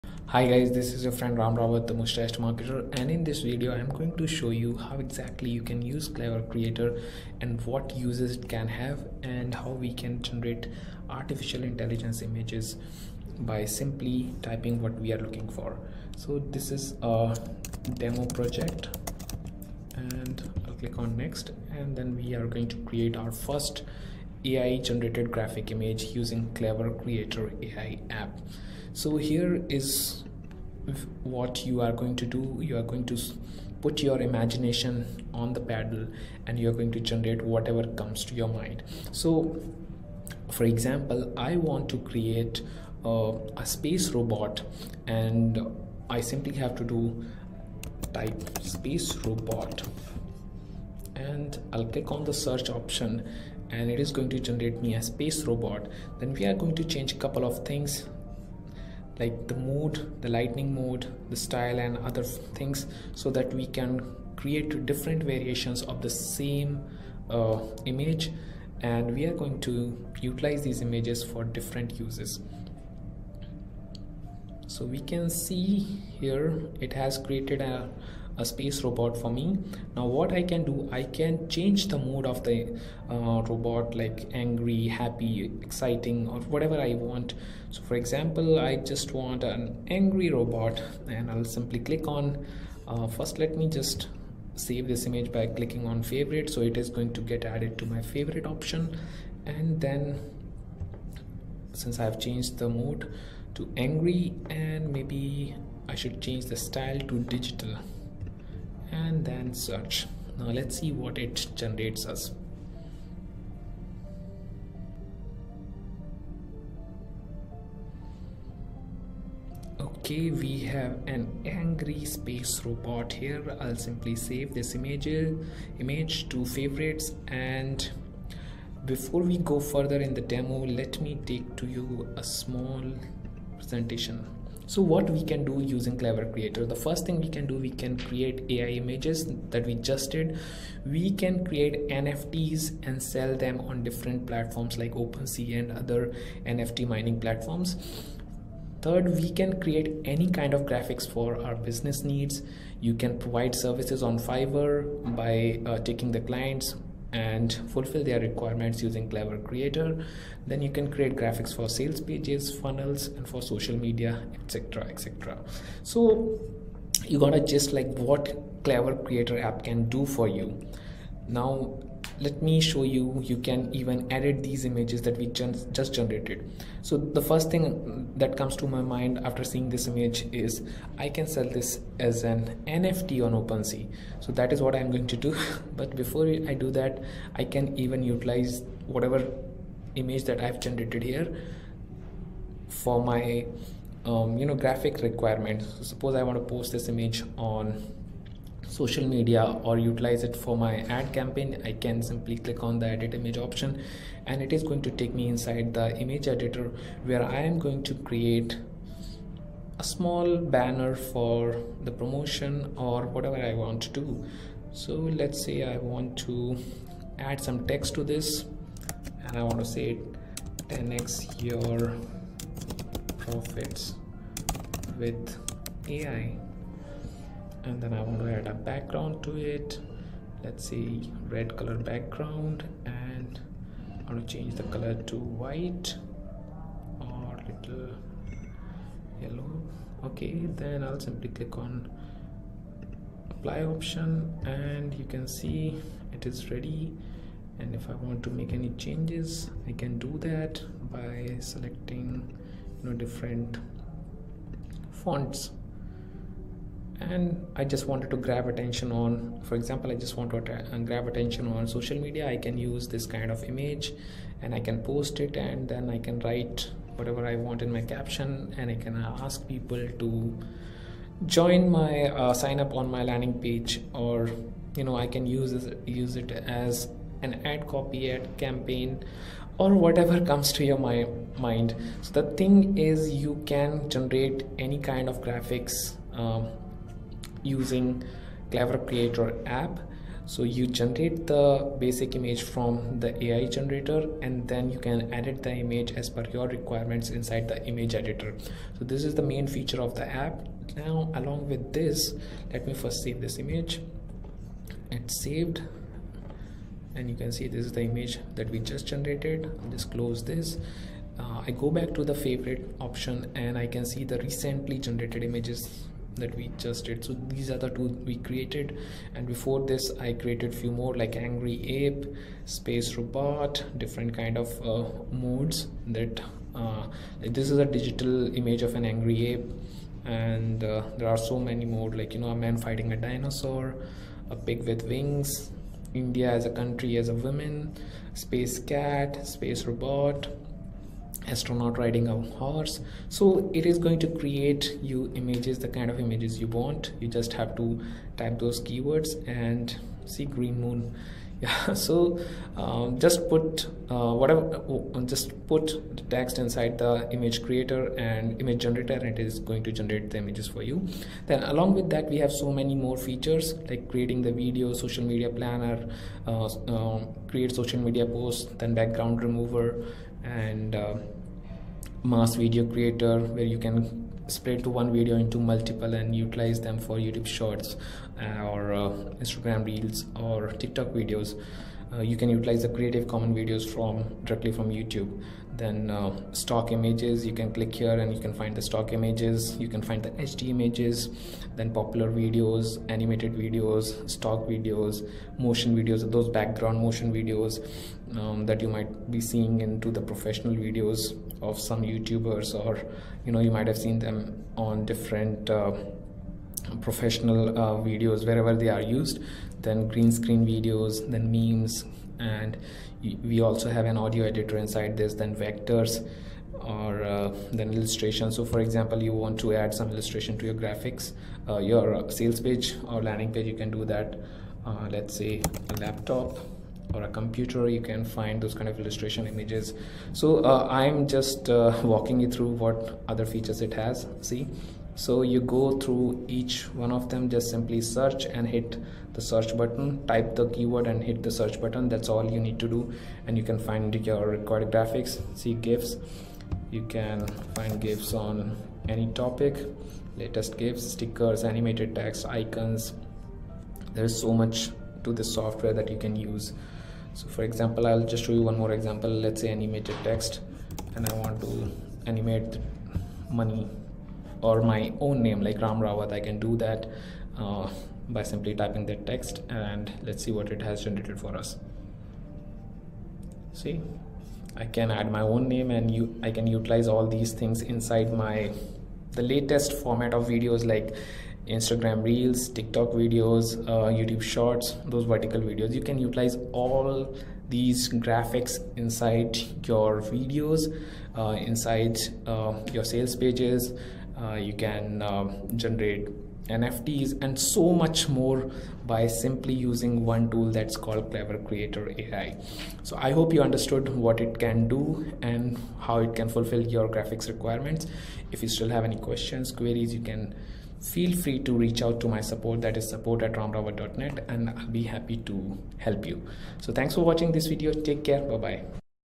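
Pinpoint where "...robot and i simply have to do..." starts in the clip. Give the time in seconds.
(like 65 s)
44 s.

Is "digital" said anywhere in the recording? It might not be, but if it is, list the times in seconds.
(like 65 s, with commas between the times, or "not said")
107 s, 327 s.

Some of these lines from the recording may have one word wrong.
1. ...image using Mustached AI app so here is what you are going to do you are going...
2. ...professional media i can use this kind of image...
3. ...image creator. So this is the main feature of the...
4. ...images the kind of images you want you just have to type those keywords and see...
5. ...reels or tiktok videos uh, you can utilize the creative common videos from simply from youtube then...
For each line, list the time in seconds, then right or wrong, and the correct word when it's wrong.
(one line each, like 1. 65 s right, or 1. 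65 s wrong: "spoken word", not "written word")
1. 25 s wrong: "KleverKreator", not "Mustached"
2. 261 s wrong: "social", not "professional"
3. 297 s wrong: "editor", not "creator"
4. 345 s right
5. 379 s wrong: "directly", not "simply".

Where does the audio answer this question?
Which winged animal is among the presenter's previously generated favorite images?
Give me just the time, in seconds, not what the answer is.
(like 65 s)
334 s.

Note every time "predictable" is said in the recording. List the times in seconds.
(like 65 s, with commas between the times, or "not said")
not said.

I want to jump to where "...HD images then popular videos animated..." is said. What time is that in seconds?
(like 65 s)
390 s.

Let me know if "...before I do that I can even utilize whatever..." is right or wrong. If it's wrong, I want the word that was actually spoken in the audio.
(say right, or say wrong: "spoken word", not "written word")
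right.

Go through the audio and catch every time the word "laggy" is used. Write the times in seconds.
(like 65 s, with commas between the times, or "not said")
not said.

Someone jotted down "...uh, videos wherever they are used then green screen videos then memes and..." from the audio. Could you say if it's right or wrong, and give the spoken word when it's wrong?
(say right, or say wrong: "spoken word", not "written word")
right.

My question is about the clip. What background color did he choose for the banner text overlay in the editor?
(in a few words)
red.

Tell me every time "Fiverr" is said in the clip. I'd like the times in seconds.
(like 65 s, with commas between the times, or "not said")
154 s.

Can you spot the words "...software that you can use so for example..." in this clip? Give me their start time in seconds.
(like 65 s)
455 s.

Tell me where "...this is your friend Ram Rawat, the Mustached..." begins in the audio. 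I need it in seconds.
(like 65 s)
0 s.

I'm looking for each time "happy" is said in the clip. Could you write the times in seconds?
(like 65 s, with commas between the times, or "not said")
84 s, 514 s.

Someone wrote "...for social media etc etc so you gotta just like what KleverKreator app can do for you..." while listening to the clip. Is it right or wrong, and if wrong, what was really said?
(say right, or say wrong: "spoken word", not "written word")
right.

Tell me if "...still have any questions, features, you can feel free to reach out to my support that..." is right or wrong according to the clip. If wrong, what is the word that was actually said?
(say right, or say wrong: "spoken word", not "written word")
wrong: "queries", not "features".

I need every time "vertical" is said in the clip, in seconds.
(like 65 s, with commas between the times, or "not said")
485 s.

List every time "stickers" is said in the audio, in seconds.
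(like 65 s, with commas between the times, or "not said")
450 s.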